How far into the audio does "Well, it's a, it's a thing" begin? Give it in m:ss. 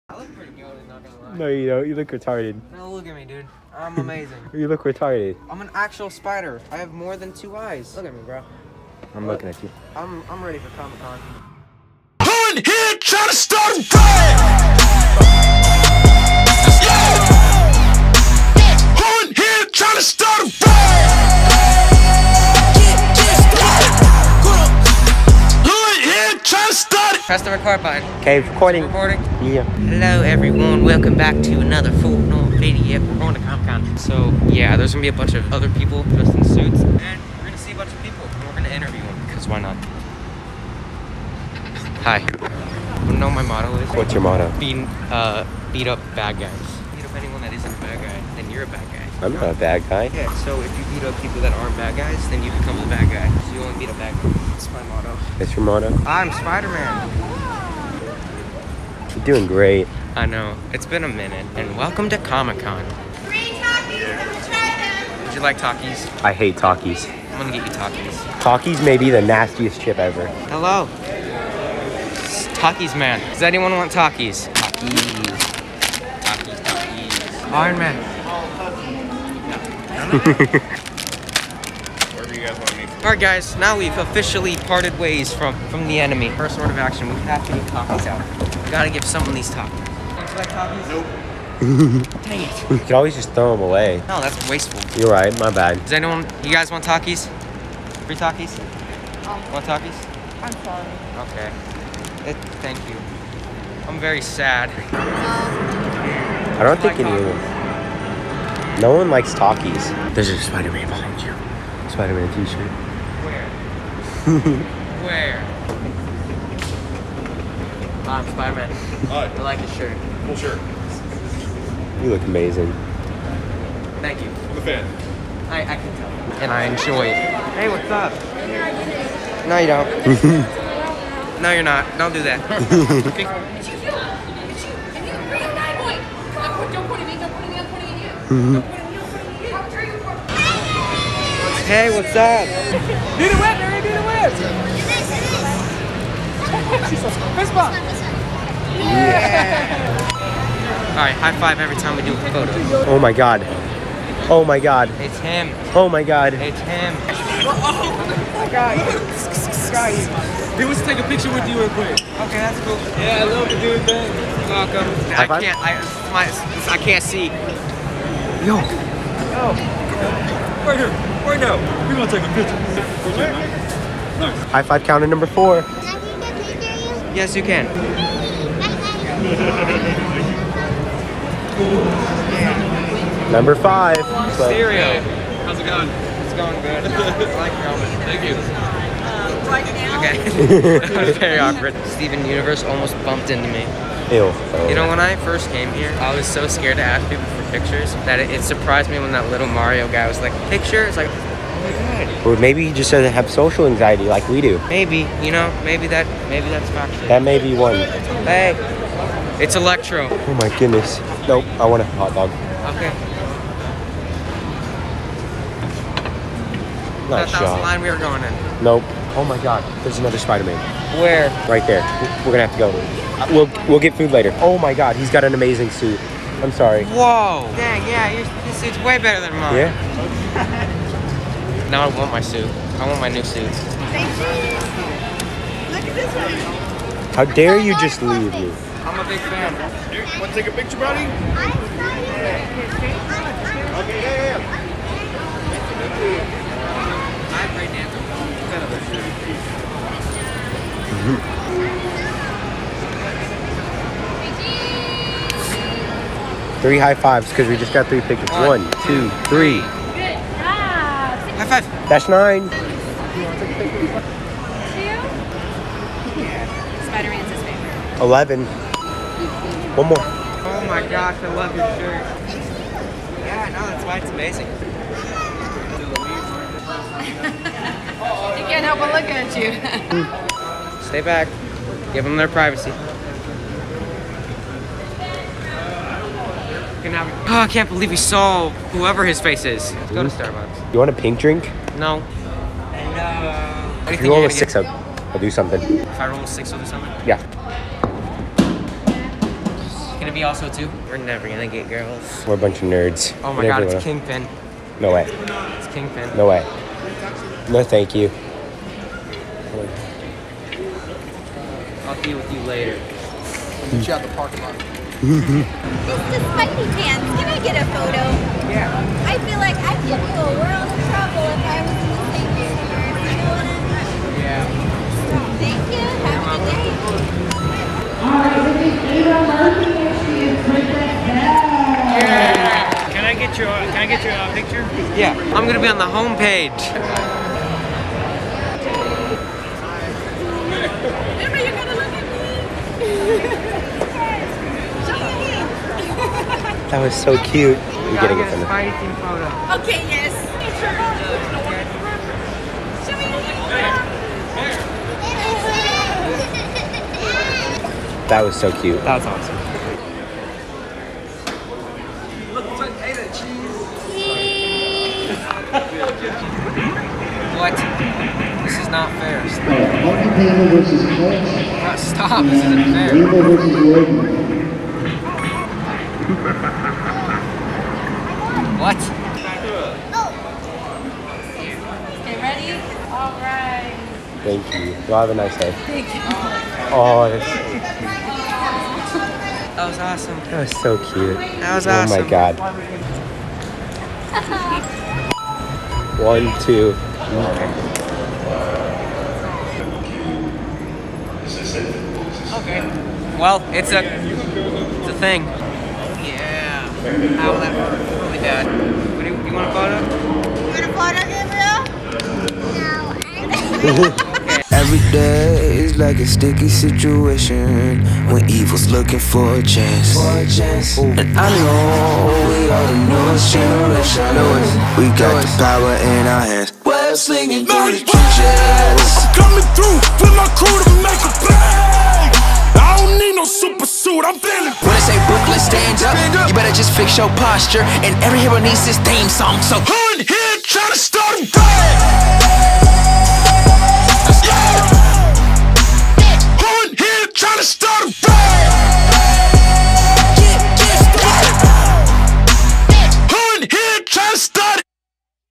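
6:43.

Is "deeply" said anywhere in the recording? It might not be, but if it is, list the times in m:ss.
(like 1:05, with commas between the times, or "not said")
not said.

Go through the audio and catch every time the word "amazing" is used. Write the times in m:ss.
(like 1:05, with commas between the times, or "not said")
0:03, 2:02, 3:45, 4:34.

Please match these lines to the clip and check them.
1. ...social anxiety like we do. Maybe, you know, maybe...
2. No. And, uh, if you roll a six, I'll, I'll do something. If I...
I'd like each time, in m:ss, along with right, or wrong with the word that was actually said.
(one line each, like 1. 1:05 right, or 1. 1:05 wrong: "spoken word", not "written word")
1. 3:23 right
2. 4:51 right.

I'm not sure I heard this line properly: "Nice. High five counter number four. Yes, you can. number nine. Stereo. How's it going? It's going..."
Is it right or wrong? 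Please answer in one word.
wrong.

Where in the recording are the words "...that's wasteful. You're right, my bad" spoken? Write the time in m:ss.
1:34.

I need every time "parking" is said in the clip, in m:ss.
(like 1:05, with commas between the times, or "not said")
5:14.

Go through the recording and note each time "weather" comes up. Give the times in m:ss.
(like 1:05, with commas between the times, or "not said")
2:23.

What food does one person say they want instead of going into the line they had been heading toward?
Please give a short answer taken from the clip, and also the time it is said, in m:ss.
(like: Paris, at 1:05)
A hot dog, at 3:31.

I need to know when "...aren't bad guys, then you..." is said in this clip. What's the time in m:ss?
0:51.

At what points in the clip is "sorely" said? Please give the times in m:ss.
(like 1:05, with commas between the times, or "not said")
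not said.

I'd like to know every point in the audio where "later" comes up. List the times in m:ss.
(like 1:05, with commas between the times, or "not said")
3:44, 5:12.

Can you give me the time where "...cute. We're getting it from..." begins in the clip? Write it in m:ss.
5:47.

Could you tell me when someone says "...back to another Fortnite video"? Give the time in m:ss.
0:31.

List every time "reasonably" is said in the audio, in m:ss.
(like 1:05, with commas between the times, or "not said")
not said.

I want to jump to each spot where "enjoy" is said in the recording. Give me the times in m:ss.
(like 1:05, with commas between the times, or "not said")
2:06.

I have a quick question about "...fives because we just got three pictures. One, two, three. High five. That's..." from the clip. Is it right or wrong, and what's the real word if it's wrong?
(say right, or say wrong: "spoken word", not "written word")
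right.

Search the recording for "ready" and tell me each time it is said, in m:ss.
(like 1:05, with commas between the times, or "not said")
0:10, 6:22.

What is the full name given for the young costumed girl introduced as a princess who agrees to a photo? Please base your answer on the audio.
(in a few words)
Ava Murphy.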